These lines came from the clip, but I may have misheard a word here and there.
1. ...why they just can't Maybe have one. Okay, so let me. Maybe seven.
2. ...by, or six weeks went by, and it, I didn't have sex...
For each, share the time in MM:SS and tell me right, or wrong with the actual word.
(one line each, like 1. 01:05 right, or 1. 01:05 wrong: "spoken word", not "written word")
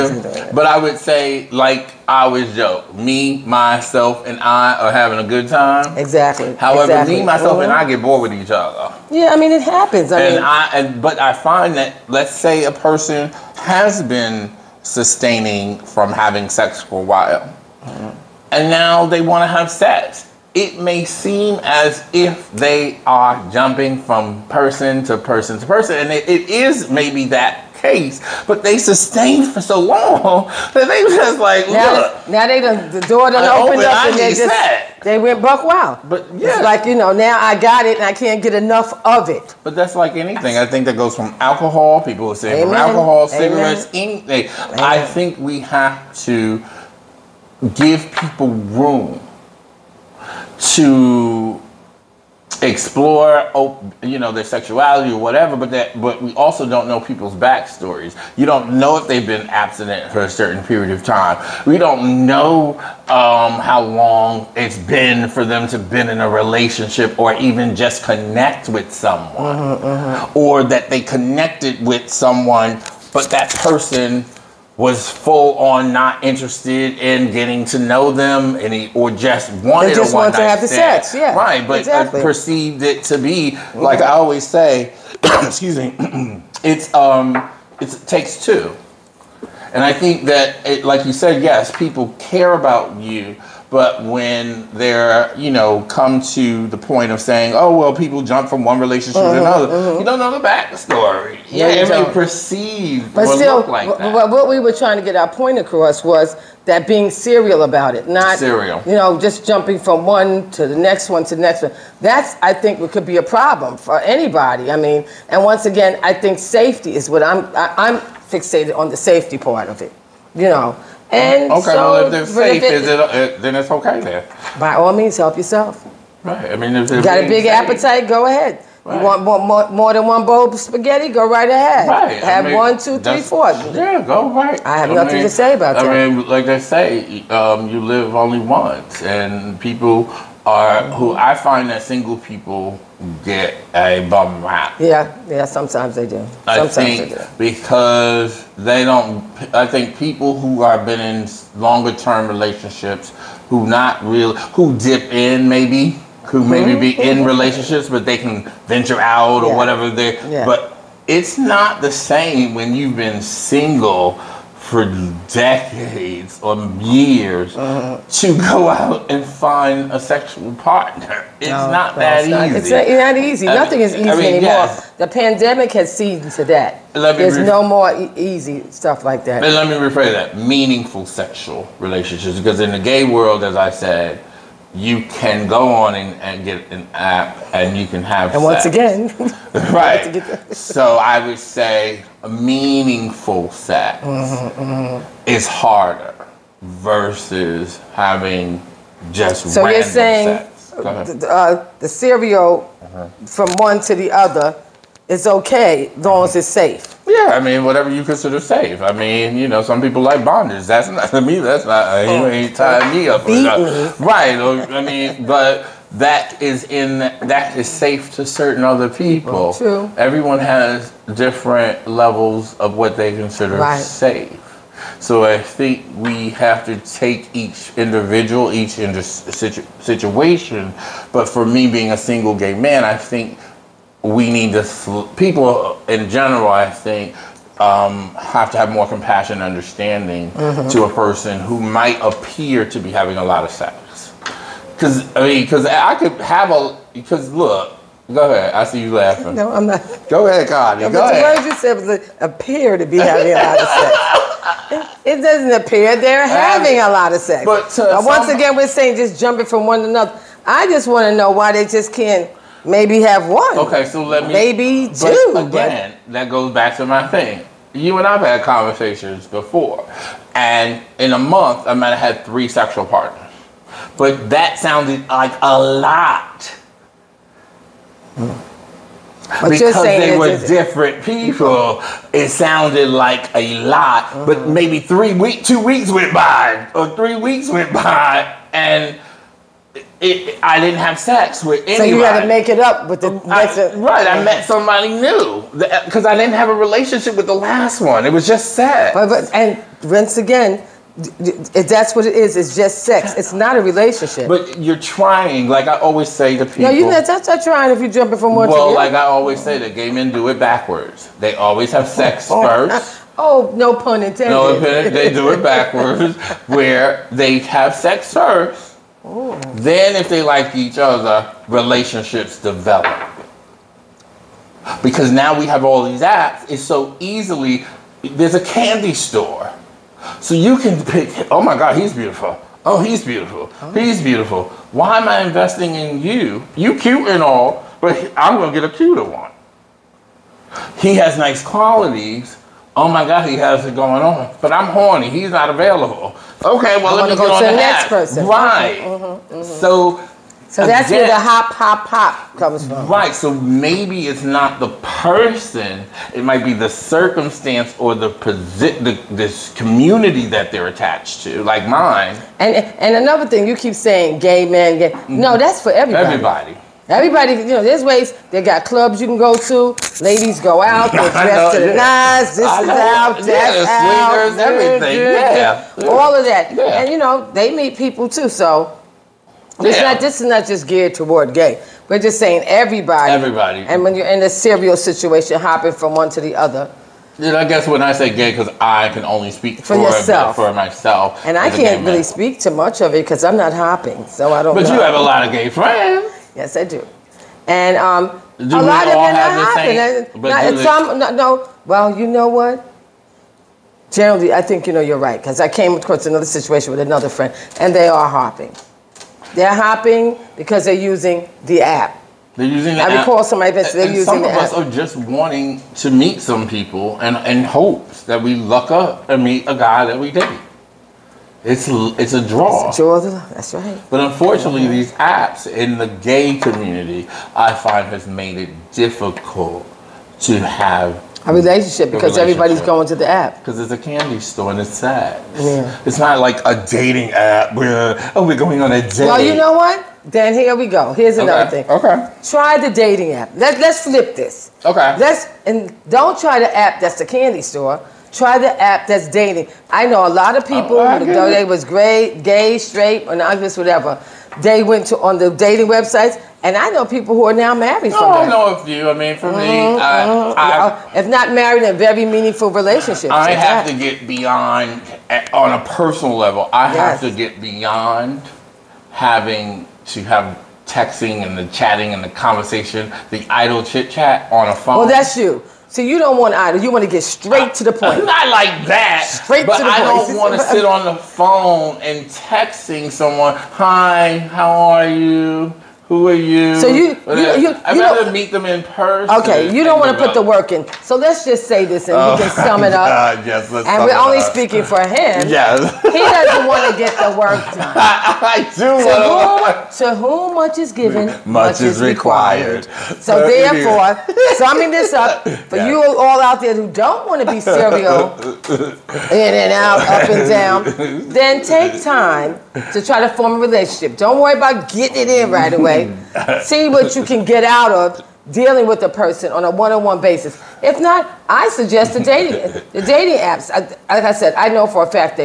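1. 04:21 wrong: "two", not "seven"
2. 04:46 wrong: "three", not "six".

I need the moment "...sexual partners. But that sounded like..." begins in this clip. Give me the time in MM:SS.
04:32.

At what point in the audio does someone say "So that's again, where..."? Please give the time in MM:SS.
05:50.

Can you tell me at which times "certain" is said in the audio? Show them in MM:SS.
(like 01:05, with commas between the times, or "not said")
01:00, 03:38.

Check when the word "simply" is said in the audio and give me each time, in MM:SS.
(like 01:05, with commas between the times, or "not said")
not said.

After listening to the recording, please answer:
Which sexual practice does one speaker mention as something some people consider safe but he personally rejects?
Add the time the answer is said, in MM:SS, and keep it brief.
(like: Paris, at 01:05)
bondage, at 03:30.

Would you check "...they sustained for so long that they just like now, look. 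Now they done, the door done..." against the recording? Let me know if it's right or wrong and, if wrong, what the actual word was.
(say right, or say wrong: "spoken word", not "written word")
right.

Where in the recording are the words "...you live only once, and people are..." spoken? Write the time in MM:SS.
02:17.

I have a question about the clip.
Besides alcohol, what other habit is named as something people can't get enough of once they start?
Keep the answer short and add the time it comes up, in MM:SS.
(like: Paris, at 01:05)
cigarettes, at 00:43.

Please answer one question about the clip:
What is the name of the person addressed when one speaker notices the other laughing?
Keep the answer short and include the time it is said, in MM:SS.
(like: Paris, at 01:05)
Connie, at 04:10.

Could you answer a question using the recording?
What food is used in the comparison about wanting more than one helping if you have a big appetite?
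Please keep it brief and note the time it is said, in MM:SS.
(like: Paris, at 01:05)
spaghetti, at 02:10.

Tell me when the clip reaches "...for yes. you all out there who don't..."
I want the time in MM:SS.
08:25.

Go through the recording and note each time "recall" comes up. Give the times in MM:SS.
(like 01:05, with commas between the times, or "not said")
06:53.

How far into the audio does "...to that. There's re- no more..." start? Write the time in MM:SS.
02:56.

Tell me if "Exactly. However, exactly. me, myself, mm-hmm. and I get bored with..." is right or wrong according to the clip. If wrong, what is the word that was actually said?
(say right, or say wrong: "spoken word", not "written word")
right.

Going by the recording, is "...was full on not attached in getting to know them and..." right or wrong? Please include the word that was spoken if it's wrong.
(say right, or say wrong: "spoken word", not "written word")
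wrong: "interested", not "attached".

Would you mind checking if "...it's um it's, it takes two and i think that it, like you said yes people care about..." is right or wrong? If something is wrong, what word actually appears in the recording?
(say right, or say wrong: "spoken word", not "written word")
right.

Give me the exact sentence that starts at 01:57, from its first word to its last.
I, am i am fixated on the safety part of it.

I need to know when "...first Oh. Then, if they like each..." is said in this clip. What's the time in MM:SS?
05:18.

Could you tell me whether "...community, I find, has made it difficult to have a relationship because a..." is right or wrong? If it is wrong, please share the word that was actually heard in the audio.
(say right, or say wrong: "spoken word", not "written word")
right.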